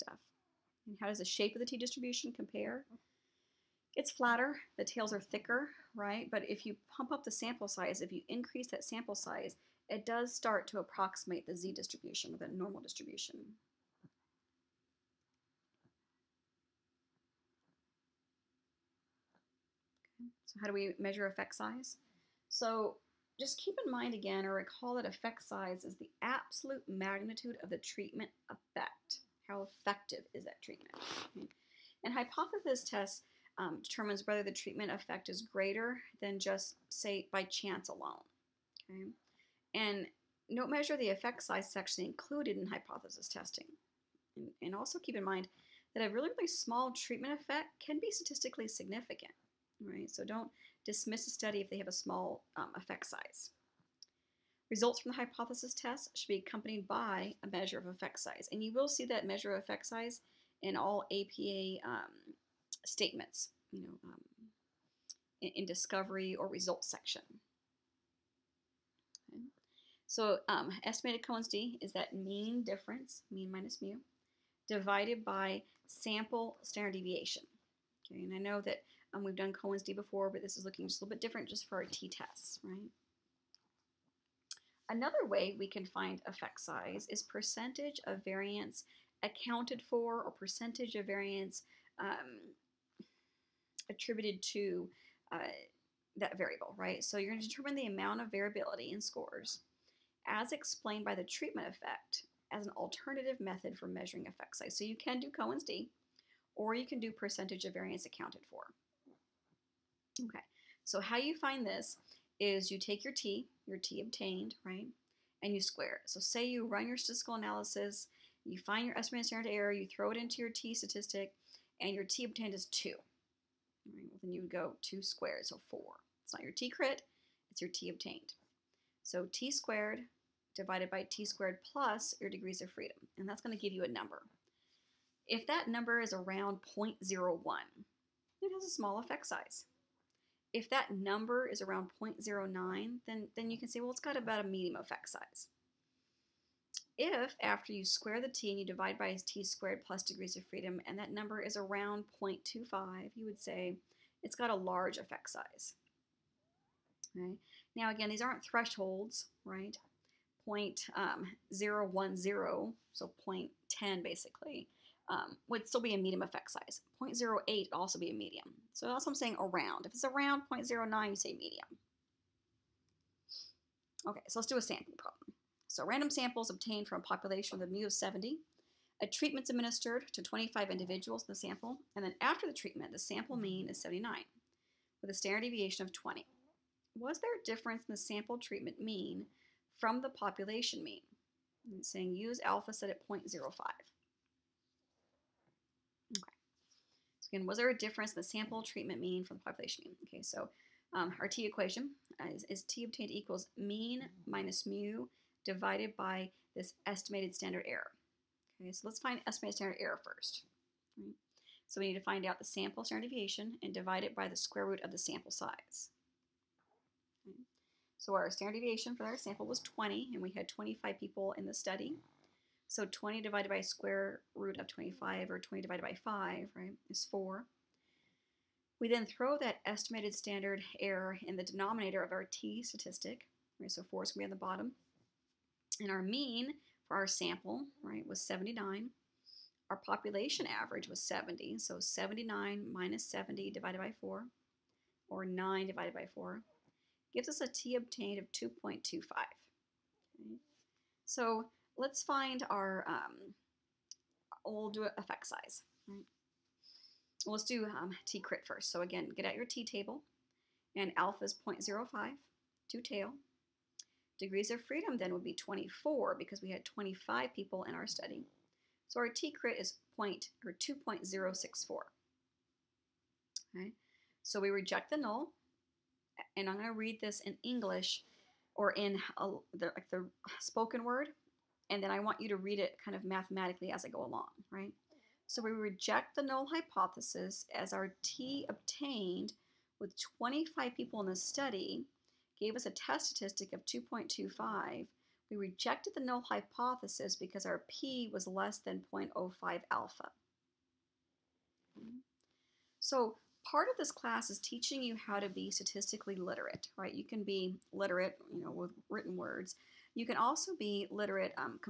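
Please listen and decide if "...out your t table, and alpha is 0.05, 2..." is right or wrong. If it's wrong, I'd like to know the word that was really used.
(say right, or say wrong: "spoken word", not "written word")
right.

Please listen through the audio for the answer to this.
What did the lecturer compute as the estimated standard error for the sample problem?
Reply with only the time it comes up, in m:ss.
3:46.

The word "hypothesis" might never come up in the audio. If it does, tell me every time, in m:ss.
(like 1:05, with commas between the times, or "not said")
0:32, 0:42, 0:55, 4:46, 4:56.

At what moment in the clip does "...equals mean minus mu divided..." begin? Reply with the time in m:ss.
3:23.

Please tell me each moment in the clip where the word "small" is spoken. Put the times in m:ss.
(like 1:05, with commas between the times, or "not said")
0:46, 0:51, 2:18.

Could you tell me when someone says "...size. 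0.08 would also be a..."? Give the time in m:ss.
2:46.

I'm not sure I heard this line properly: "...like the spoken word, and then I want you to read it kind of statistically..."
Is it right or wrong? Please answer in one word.
wrong.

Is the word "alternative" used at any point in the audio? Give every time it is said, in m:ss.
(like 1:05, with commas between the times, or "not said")
1:42.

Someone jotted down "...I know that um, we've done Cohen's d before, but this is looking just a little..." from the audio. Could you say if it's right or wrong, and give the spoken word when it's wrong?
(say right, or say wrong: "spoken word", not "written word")
right.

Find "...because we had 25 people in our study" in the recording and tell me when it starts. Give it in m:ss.
4:26.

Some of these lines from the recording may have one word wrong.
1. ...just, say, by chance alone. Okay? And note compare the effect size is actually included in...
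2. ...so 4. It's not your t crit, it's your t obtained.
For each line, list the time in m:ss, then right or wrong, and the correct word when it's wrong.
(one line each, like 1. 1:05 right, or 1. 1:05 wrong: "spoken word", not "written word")
1. 0:36 wrong: "measure", not "compare"
2. 2:05 right.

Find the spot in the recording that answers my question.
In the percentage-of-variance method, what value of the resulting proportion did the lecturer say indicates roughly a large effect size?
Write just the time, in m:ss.
2:32.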